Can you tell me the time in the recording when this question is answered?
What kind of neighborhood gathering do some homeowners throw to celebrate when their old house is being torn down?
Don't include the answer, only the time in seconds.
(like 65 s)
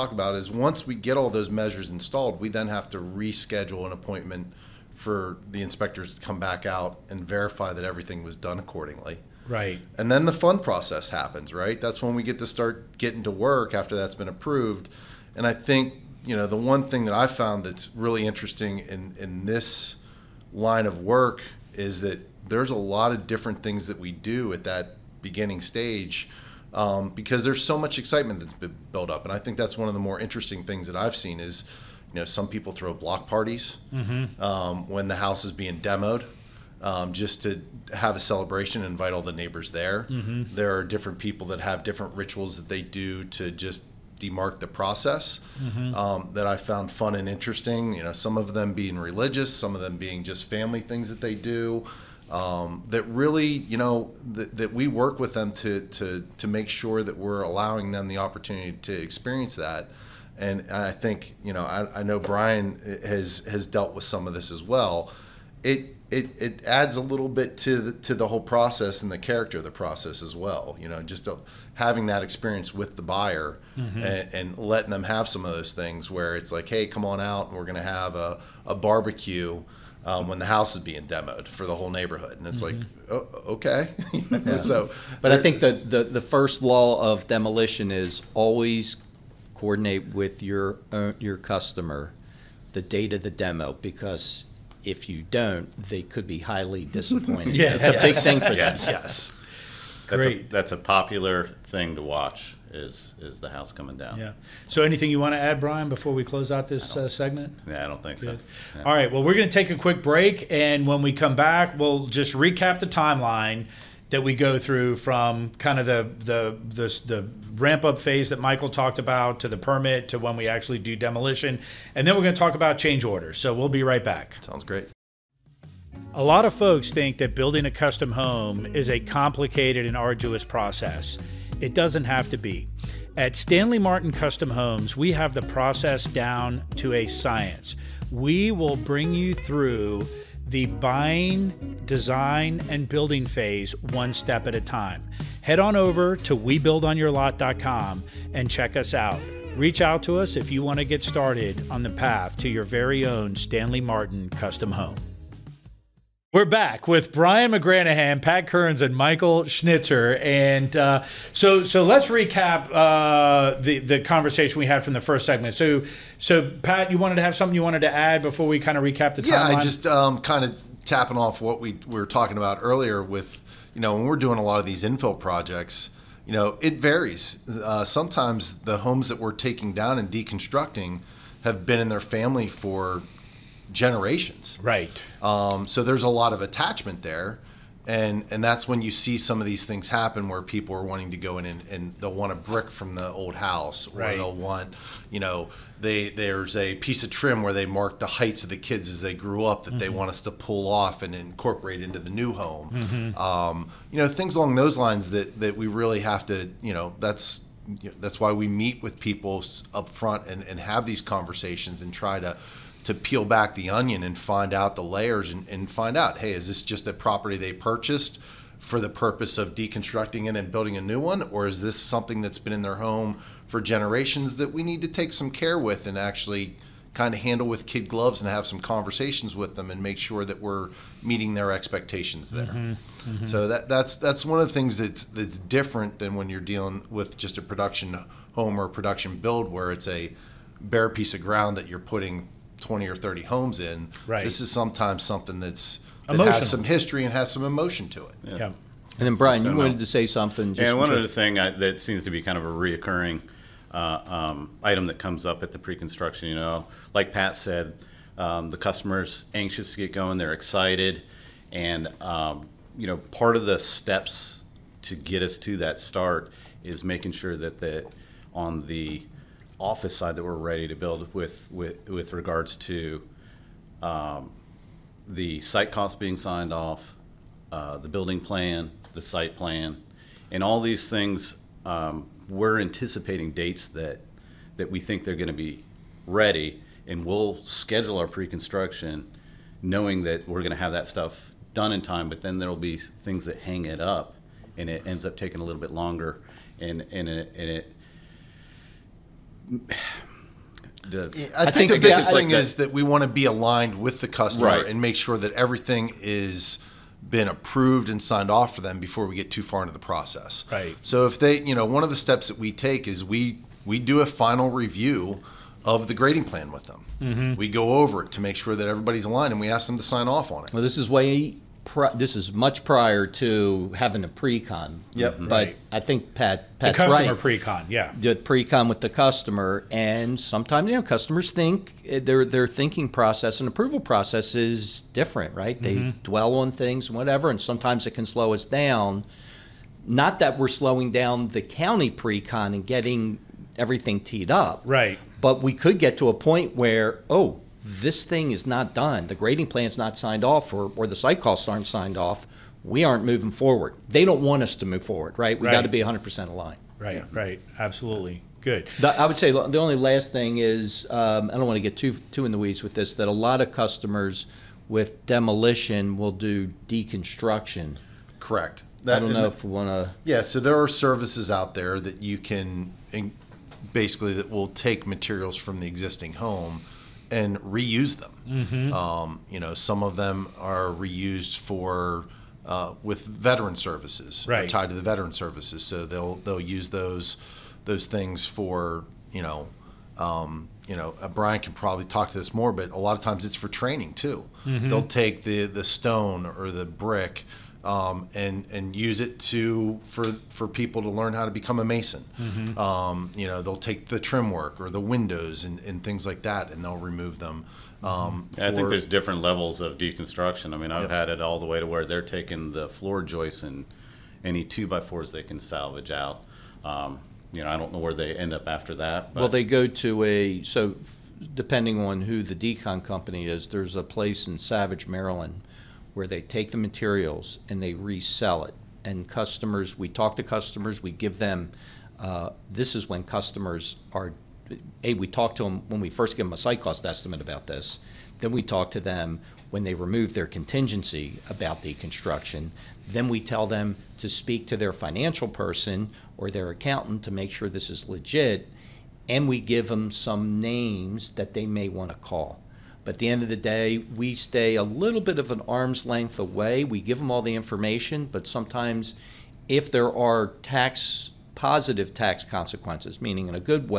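32 s.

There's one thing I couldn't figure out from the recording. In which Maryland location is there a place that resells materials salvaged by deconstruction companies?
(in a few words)
Savage.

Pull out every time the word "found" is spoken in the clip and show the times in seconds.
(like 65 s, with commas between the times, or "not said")
17 s, 46 s.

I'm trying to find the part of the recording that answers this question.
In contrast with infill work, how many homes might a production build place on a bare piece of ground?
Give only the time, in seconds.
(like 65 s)
242 s.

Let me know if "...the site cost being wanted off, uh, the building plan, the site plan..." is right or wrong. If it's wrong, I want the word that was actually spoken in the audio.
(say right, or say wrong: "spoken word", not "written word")
wrong: "signed", not "wanted".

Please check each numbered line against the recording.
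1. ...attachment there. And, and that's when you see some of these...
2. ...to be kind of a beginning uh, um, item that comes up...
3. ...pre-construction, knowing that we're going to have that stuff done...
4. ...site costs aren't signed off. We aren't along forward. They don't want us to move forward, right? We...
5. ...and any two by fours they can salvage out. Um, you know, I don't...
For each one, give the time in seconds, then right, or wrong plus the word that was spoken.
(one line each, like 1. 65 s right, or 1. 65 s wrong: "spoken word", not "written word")
1. 186 s right
2. 252 s wrong: "reoccurring", not "beginning"
3. 288 s right
4. 350 s wrong: "moving", not "along"
5. 413 s right.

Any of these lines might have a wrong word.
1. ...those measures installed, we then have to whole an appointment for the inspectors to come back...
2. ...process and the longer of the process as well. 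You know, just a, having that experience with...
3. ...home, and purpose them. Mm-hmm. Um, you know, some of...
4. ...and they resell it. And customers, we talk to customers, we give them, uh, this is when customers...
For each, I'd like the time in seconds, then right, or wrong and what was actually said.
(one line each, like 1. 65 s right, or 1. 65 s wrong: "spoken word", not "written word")
1. 1 s wrong: "reschedule", not "whole"
2. 68 s wrong: "character", not "longer"
3. 376 s wrong: "reuse", not "purpose"
4. 427 s right.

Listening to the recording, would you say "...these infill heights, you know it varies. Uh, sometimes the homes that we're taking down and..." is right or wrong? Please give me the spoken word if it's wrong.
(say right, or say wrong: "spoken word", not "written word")
wrong: "projects", not "heights".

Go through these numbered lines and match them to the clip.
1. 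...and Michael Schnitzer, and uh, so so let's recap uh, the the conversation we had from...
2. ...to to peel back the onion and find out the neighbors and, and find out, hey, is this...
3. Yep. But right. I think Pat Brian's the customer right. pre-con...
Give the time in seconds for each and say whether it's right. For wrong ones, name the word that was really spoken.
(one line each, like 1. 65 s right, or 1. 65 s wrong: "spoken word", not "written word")
1. 158 s right
2. 212 s wrong: "layers", not "neighbors"
3. 324 s wrong: "Pat", not "Brian".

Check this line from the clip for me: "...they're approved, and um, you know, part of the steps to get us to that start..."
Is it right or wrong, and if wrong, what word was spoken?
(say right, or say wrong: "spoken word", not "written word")
wrong: "excited", not "approved".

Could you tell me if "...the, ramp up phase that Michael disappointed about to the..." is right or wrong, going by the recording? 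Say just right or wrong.
wrong.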